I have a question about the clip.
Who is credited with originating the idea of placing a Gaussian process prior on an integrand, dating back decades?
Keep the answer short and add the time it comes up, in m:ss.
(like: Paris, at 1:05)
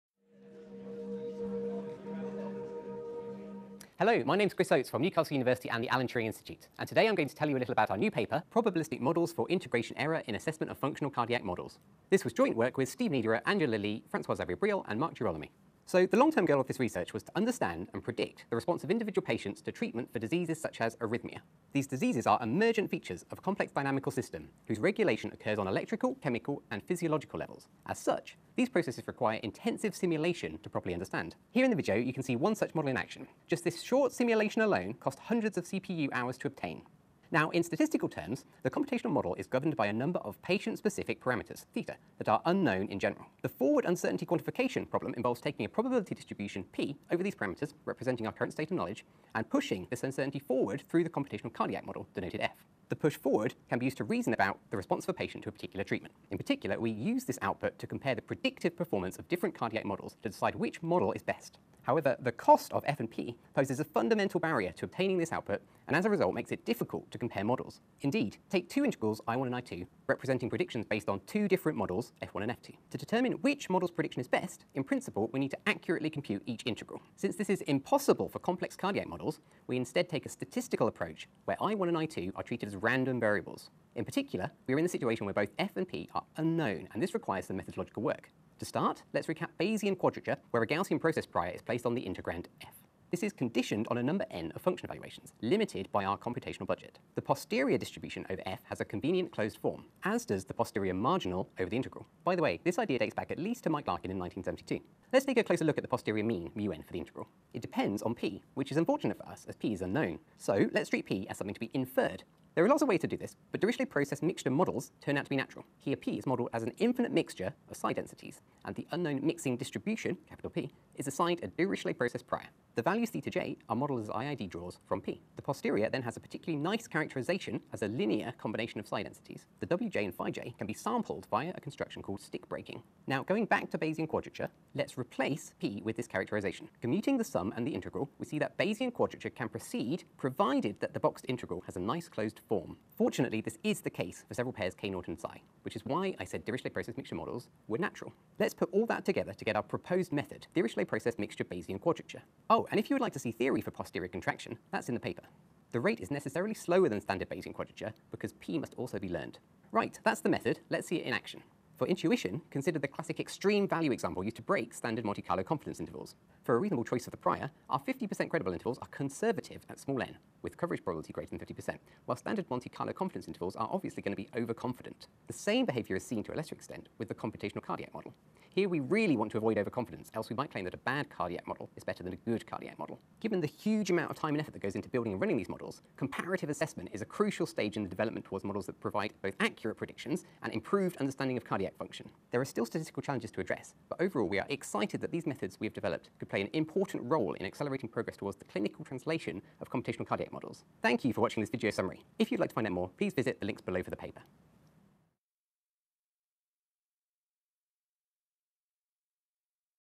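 Mike Larkin, at 1:43.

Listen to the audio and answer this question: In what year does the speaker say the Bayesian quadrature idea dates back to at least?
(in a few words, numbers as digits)
1972.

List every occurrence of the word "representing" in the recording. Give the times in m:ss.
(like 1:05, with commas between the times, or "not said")
0:47, 1:10.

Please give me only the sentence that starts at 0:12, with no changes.
This was joint work with Steve Niederer, Angela Lee, Francois-Xavier Briol, and Mark Girolami.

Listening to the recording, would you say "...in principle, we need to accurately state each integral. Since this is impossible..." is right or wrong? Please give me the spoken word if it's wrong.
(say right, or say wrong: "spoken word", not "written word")
wrong: "compute", not "state".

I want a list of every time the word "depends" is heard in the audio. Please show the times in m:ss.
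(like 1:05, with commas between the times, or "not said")
1:47.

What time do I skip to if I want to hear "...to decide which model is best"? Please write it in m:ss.
1:00.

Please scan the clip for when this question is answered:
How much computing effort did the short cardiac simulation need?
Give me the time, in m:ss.
0:35.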